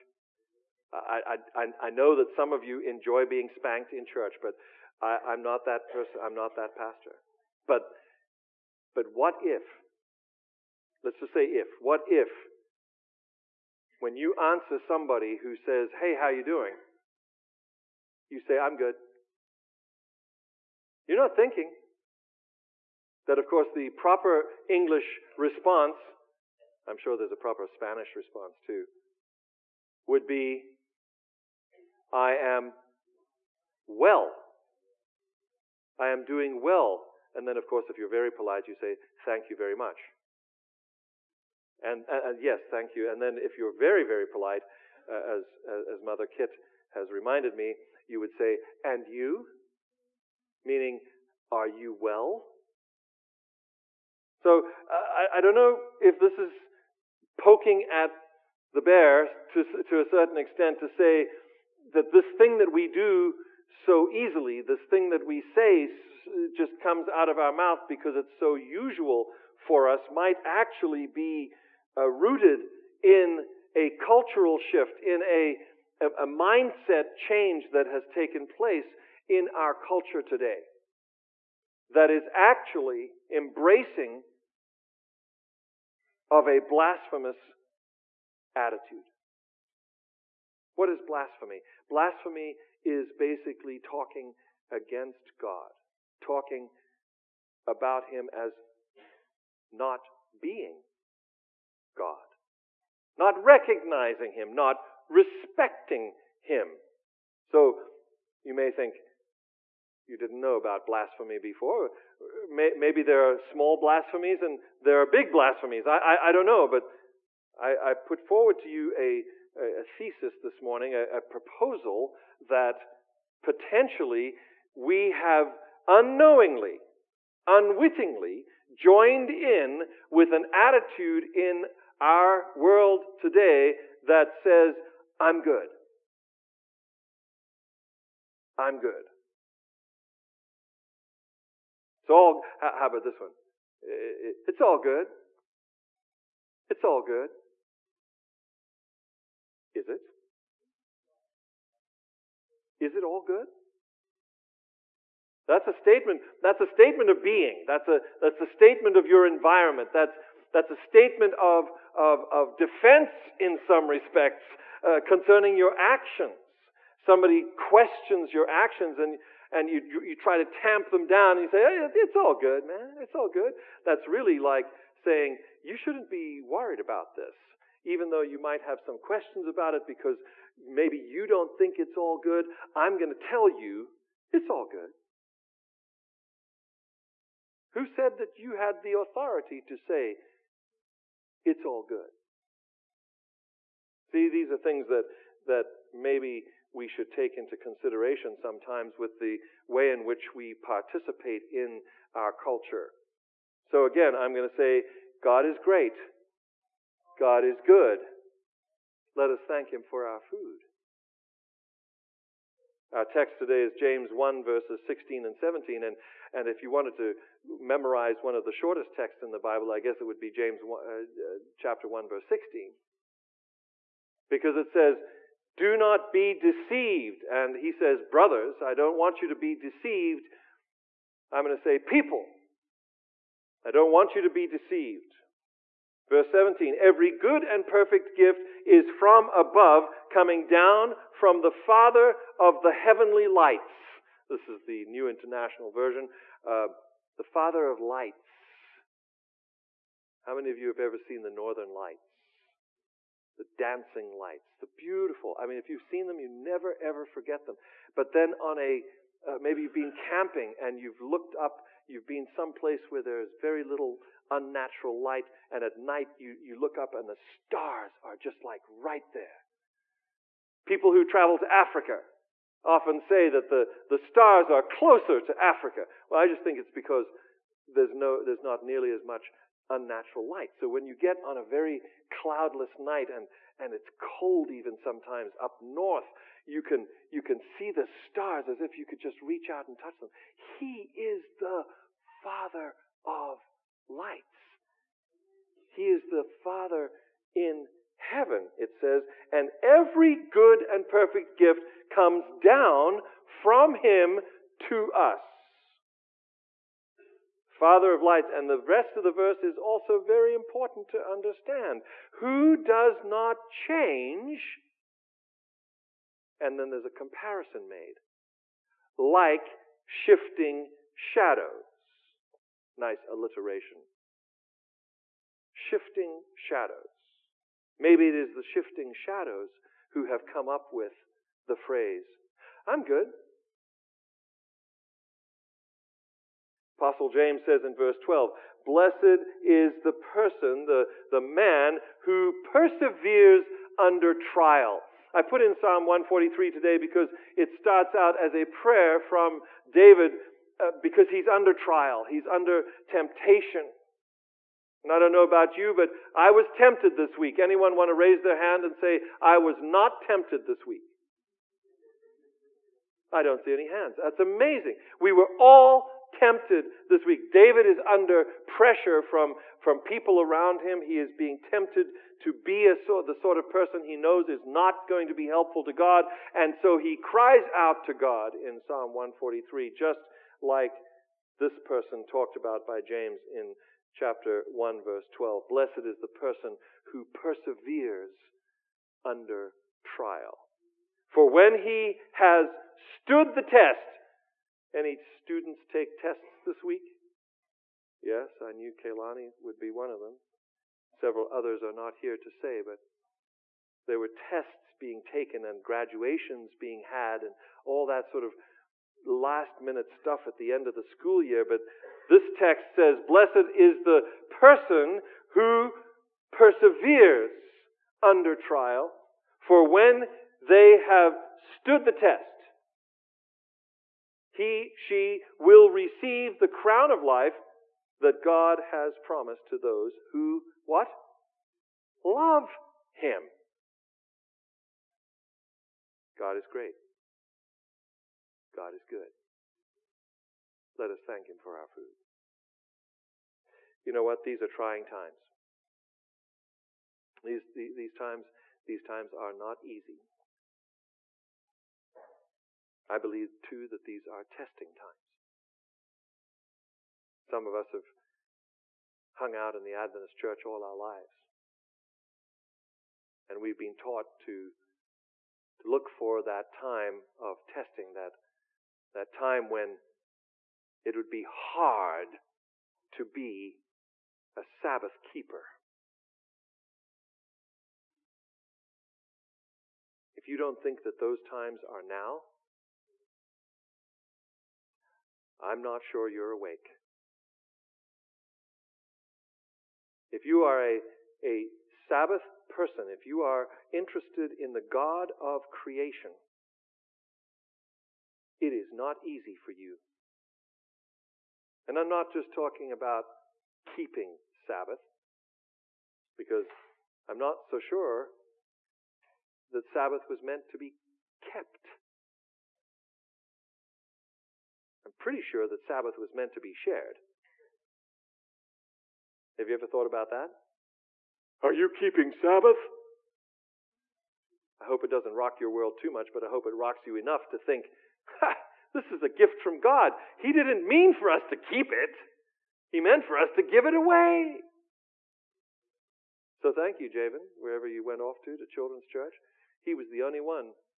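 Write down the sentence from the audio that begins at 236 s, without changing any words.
Verse 17, every good and perfect gift is from above, coming down from the Father of the heavenly lights.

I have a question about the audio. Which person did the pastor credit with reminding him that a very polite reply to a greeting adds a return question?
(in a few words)
Mother Kit.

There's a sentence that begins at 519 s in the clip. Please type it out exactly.
Have you ever thought about that?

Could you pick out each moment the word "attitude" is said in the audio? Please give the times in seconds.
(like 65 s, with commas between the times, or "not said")
88 s, 130 s.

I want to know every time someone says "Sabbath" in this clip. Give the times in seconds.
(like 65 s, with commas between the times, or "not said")
474 s, 491 s, 504 s, 509 s, 515 s, 522 s.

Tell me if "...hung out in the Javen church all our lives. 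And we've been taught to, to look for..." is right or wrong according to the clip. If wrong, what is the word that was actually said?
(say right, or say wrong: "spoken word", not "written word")
wrong: "Adventist", not "Javen".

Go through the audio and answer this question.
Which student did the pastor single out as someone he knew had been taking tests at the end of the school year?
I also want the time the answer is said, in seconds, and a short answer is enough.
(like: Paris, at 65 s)
Kalani, at 398 s.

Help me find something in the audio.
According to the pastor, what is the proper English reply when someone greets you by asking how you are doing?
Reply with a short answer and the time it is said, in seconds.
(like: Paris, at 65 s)
I am well, at 32 s.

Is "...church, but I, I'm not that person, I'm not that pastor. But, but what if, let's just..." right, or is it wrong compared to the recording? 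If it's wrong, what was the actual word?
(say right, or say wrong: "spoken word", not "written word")
right.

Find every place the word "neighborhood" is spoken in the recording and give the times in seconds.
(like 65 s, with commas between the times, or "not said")
not said.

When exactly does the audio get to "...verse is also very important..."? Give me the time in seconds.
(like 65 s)
309 s.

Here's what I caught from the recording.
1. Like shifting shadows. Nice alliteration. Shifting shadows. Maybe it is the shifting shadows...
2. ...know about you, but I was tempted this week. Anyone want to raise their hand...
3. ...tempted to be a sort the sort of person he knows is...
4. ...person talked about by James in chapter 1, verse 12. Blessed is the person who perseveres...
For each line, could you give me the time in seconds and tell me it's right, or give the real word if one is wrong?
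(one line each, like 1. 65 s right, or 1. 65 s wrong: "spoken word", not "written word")
1. 318 s right
2. 355 s right
3. 371 s right
4. 381 s right.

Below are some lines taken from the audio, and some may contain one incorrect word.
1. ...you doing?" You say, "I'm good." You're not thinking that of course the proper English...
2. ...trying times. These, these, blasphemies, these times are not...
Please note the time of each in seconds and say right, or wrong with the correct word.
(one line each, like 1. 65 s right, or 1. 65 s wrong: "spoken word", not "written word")
1. 16 s right
2. 444 s wrong: "times", not "blasphemies".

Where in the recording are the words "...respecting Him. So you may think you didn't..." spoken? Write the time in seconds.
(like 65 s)
105 s.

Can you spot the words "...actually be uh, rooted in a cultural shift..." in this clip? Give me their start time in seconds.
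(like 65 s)
70 s.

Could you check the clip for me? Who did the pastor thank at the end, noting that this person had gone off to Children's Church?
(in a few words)
Javen.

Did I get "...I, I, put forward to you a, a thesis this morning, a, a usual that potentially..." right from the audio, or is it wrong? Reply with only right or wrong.
wrong.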